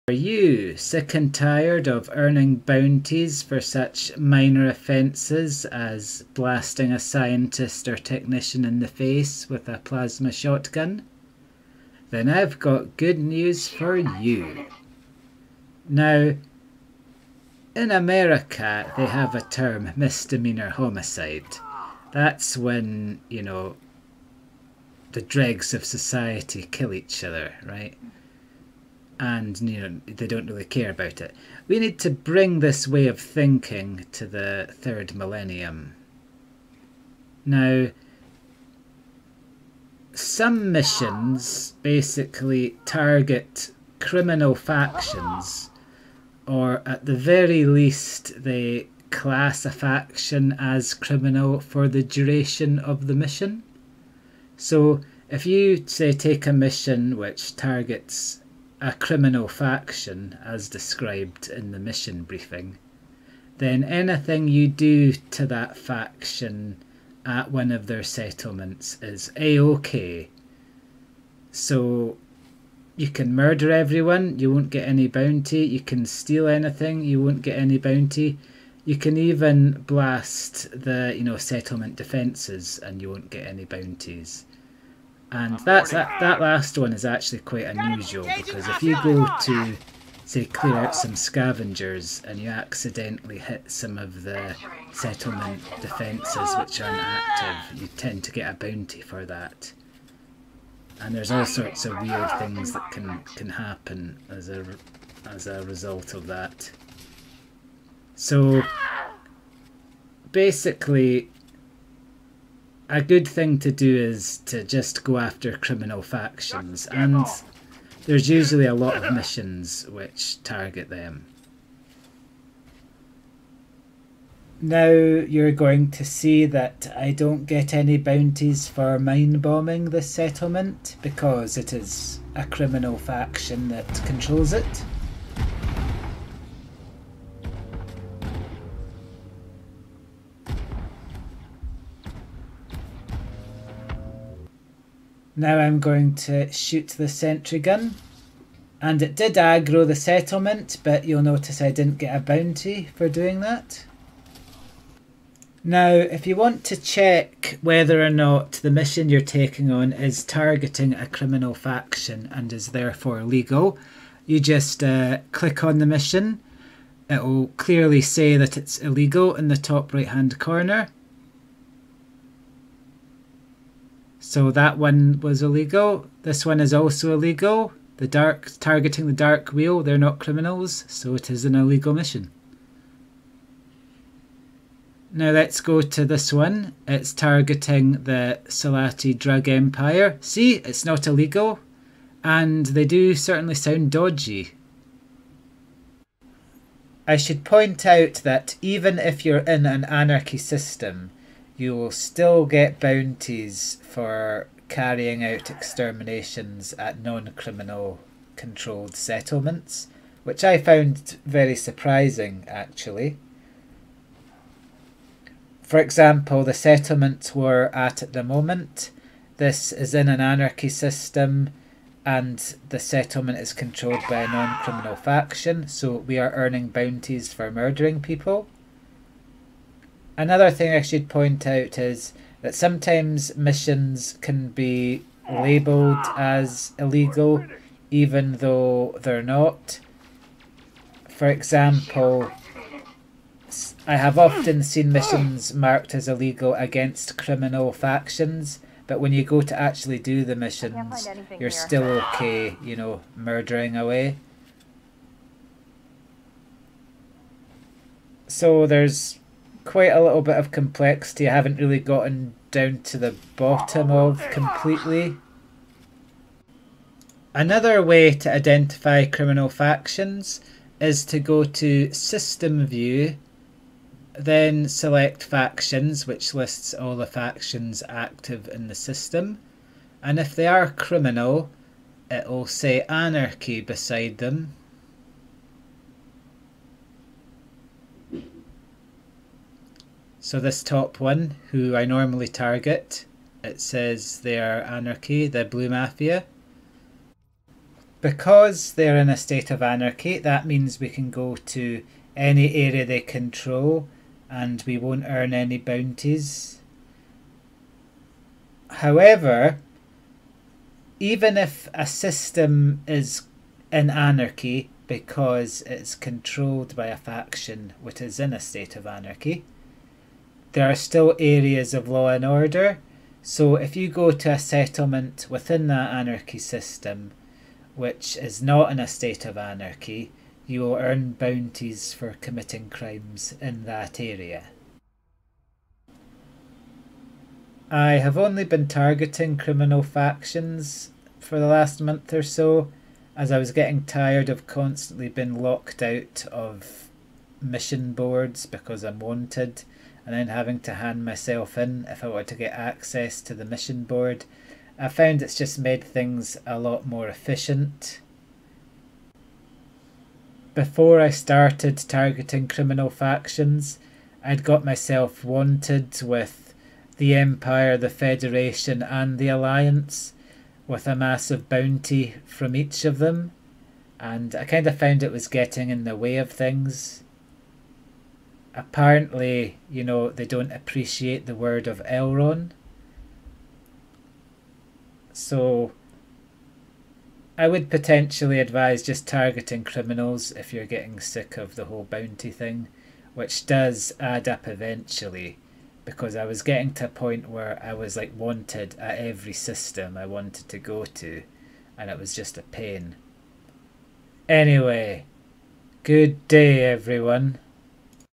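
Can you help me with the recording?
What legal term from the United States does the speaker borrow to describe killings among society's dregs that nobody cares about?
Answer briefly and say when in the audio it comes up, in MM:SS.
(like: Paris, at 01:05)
misdemeanor homicide, at 00:19.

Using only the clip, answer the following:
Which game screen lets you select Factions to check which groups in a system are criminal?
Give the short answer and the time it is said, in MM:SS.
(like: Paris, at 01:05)
System View, at 04:31.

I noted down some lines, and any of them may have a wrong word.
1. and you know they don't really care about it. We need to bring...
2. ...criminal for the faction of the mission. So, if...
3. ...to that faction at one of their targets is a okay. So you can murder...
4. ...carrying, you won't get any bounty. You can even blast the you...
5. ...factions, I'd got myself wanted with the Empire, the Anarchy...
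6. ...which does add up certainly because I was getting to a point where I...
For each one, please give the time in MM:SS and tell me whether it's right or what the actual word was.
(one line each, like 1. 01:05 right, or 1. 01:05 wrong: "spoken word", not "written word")
1. 00:29 right
2. 00:50 wrong: "duration", not "faction"
3. 01:05 wrong: "settlements", not "targets"
4. 01:16 wrong: "anything", not "carrying"
5. 06:02 wrong: "Federation", not "Anarchy"
6. 06:33 wrong: "eventually", not "certainly".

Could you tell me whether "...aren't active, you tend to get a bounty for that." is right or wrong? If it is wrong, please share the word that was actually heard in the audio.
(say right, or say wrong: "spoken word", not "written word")
right.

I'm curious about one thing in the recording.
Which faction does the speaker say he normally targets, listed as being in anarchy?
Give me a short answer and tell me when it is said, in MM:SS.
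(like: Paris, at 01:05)
the blue mafia, at 04:55.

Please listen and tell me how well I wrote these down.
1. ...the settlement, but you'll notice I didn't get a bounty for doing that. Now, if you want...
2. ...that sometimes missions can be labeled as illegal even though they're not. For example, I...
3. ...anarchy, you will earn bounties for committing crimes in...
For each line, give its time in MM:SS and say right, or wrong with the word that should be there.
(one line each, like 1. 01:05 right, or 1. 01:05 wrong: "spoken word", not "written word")
1. 02:29 right
2. 03:52 right
3. 05:29 right.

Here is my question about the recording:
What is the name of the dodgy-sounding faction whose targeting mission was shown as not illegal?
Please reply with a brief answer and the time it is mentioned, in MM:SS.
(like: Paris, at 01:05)
Salati drug empire, at 03:08.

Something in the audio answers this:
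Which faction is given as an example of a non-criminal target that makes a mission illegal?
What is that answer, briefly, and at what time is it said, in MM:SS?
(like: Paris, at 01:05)
the Dark Wheel, at 02:59.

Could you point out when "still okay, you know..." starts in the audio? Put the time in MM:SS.
04:11.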